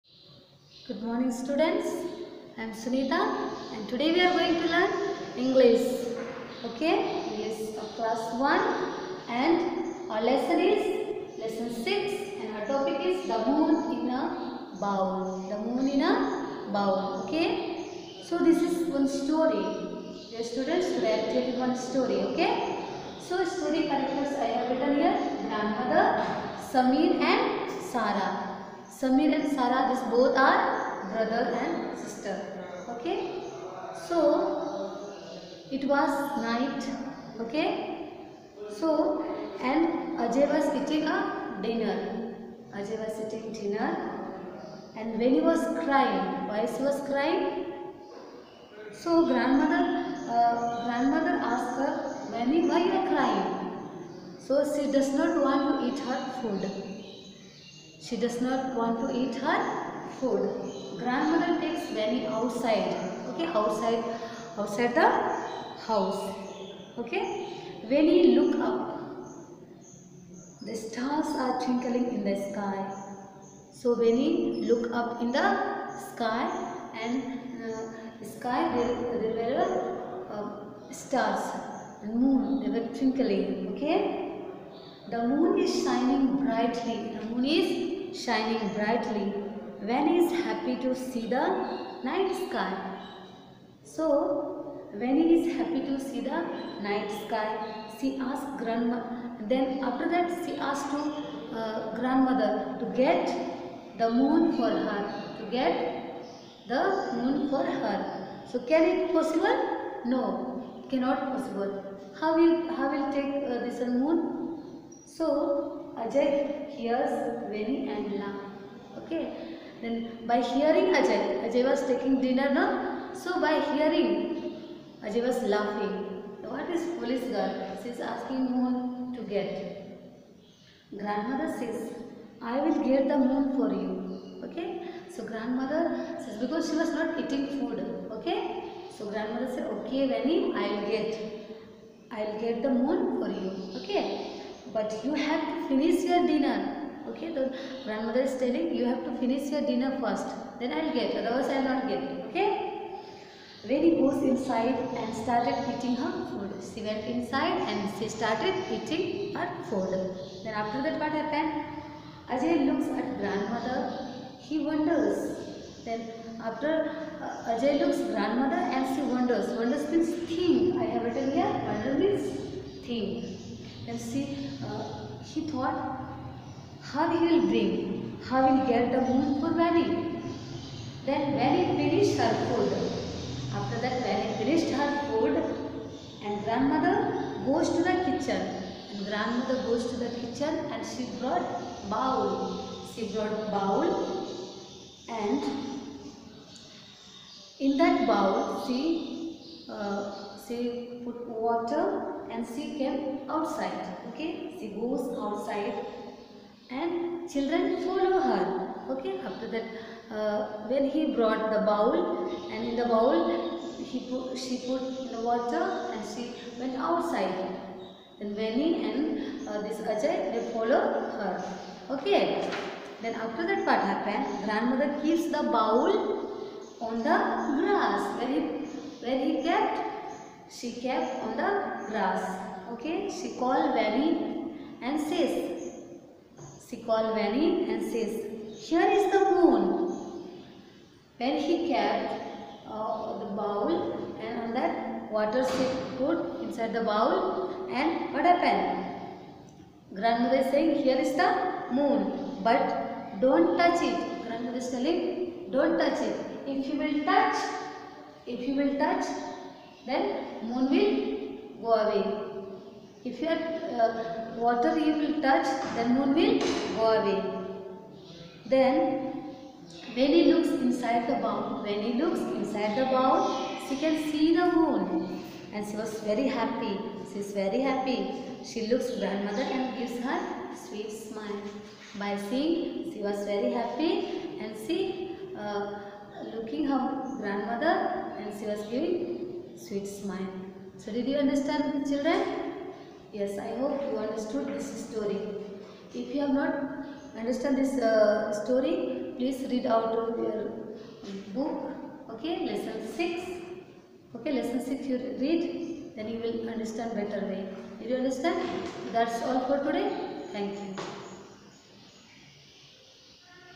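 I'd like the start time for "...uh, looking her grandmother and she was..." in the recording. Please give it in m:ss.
4:45.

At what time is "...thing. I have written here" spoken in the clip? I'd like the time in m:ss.
2:50.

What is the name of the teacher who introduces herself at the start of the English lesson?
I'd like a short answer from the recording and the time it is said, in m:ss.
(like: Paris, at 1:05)
Sunita, at 0:02.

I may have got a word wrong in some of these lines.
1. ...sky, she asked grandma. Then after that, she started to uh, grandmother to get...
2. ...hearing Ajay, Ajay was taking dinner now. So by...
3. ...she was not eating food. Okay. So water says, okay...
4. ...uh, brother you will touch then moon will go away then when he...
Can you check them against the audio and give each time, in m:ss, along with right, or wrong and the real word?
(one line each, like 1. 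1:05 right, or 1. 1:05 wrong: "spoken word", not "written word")
1. 1:37 wrong: "asked", not "started"
2. 2:00 right
3. 2:16 wrong: "grandmother", not "water"
4. 4:23 wrong: "water", not "brother".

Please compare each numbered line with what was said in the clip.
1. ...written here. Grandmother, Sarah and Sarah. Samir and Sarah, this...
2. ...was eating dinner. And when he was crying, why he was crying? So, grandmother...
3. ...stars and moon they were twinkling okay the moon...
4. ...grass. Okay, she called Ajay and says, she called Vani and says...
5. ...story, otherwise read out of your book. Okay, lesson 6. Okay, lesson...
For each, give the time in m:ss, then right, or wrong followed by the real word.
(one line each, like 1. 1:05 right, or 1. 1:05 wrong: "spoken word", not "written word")
1. 0:24 wrong: "Samir", not "Sarah"
2. 0:43 right
3. 1:20 right
4. 3:51 wrong: "Vani", not "Ajay"
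5. 4:58 wrong: "please", not "otherwise".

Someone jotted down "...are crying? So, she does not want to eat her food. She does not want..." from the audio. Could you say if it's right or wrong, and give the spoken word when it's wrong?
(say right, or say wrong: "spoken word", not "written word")
right.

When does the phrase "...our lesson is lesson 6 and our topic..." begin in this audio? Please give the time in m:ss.
0:10.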